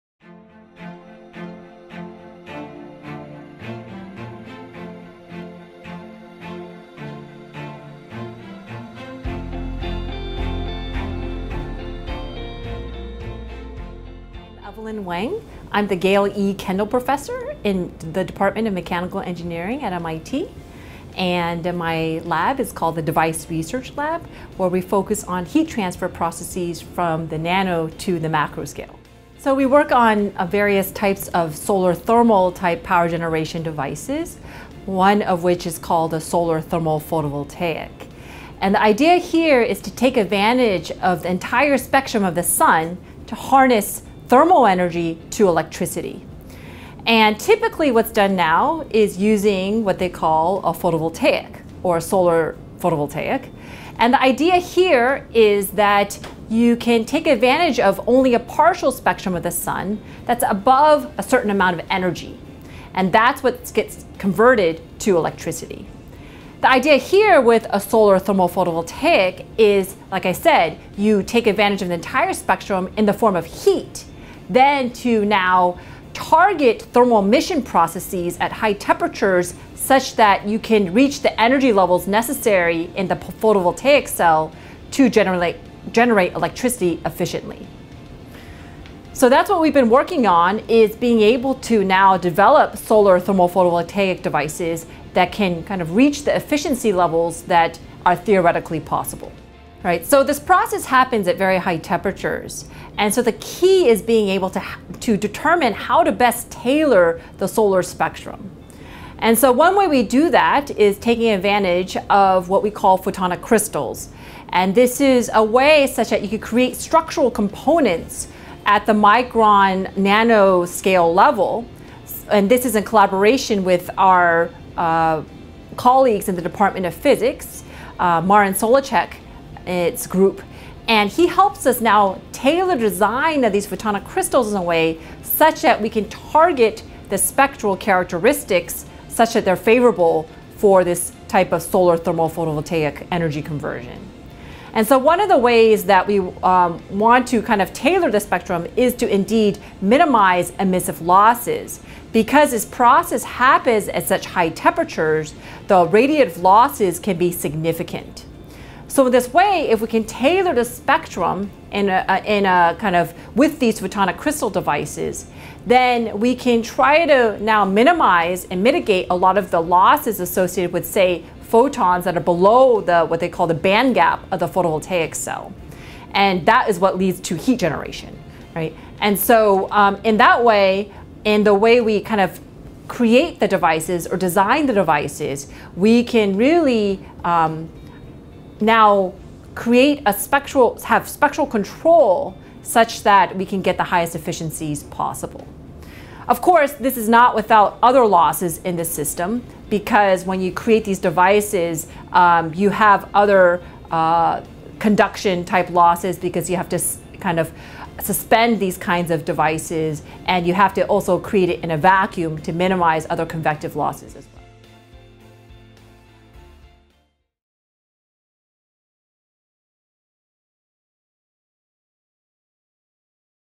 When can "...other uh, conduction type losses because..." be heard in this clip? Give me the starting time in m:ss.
3:23.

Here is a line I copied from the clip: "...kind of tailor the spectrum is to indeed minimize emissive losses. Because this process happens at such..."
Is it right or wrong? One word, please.
right.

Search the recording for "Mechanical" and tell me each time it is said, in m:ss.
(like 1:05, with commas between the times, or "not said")
0:18.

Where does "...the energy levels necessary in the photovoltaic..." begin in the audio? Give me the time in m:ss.
1:21.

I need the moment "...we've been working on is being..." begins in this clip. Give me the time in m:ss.
1:29.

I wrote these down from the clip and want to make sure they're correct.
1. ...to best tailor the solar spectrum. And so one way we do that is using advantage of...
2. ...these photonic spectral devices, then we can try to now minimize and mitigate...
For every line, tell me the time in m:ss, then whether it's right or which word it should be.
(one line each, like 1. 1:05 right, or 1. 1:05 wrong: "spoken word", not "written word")
1. 1:46 wrong: "taking", not "using"
2. 2:43 wrong: "crystal", not "spectral".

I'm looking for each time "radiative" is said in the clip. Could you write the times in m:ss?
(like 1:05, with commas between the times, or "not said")
2:35.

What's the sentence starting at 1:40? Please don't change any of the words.
So this process happens at very high temperatures.